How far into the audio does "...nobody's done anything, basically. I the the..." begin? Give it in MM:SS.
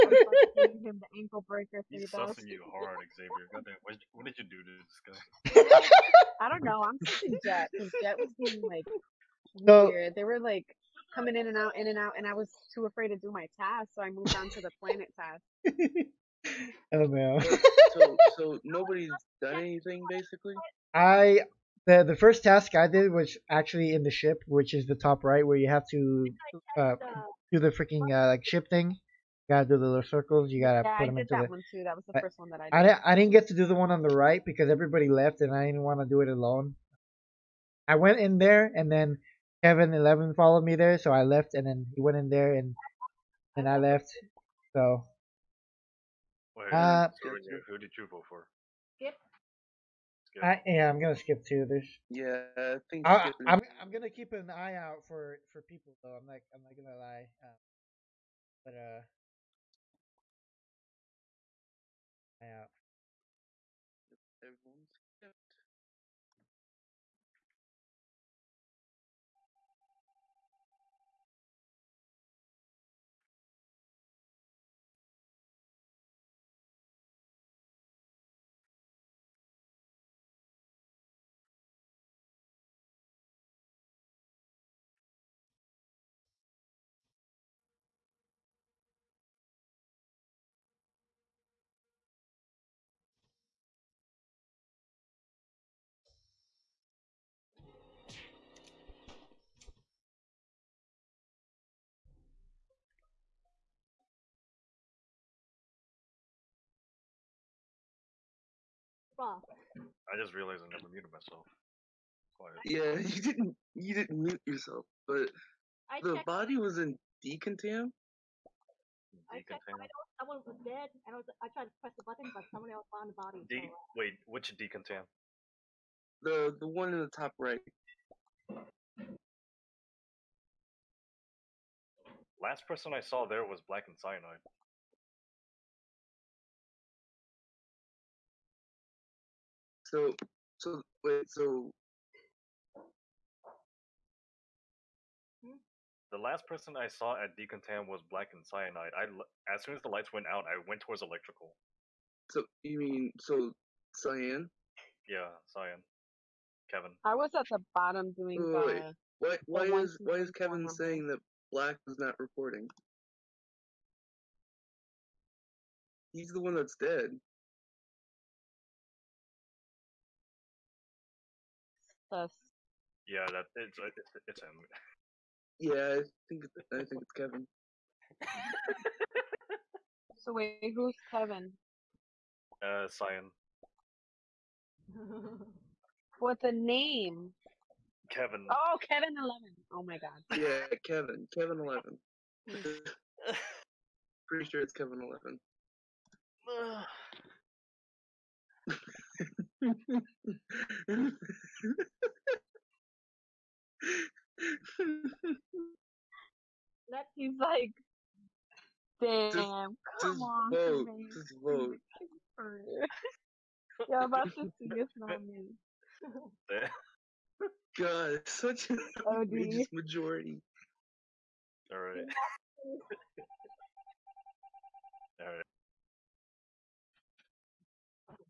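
00:18.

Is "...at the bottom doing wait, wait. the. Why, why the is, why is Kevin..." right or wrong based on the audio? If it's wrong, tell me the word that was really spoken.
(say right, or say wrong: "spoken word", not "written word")
right.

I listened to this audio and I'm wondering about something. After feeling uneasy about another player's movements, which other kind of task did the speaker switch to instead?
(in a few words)
planet task.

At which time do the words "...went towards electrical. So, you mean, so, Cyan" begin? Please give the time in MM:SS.
02:30.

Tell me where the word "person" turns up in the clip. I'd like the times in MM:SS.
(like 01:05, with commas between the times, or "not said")
02:12, 02:26.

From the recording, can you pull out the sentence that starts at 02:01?
I tried to press the button, but someone else found the body.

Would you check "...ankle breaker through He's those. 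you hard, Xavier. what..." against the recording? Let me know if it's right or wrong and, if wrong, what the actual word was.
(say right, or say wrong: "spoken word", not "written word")
right.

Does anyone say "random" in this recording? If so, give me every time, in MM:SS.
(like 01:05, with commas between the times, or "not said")
not said.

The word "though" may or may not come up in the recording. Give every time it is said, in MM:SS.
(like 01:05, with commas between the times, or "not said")
00:56.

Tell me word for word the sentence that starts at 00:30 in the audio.
You gotta yeah, put I them into that the.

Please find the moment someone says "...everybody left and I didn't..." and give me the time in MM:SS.
00:34.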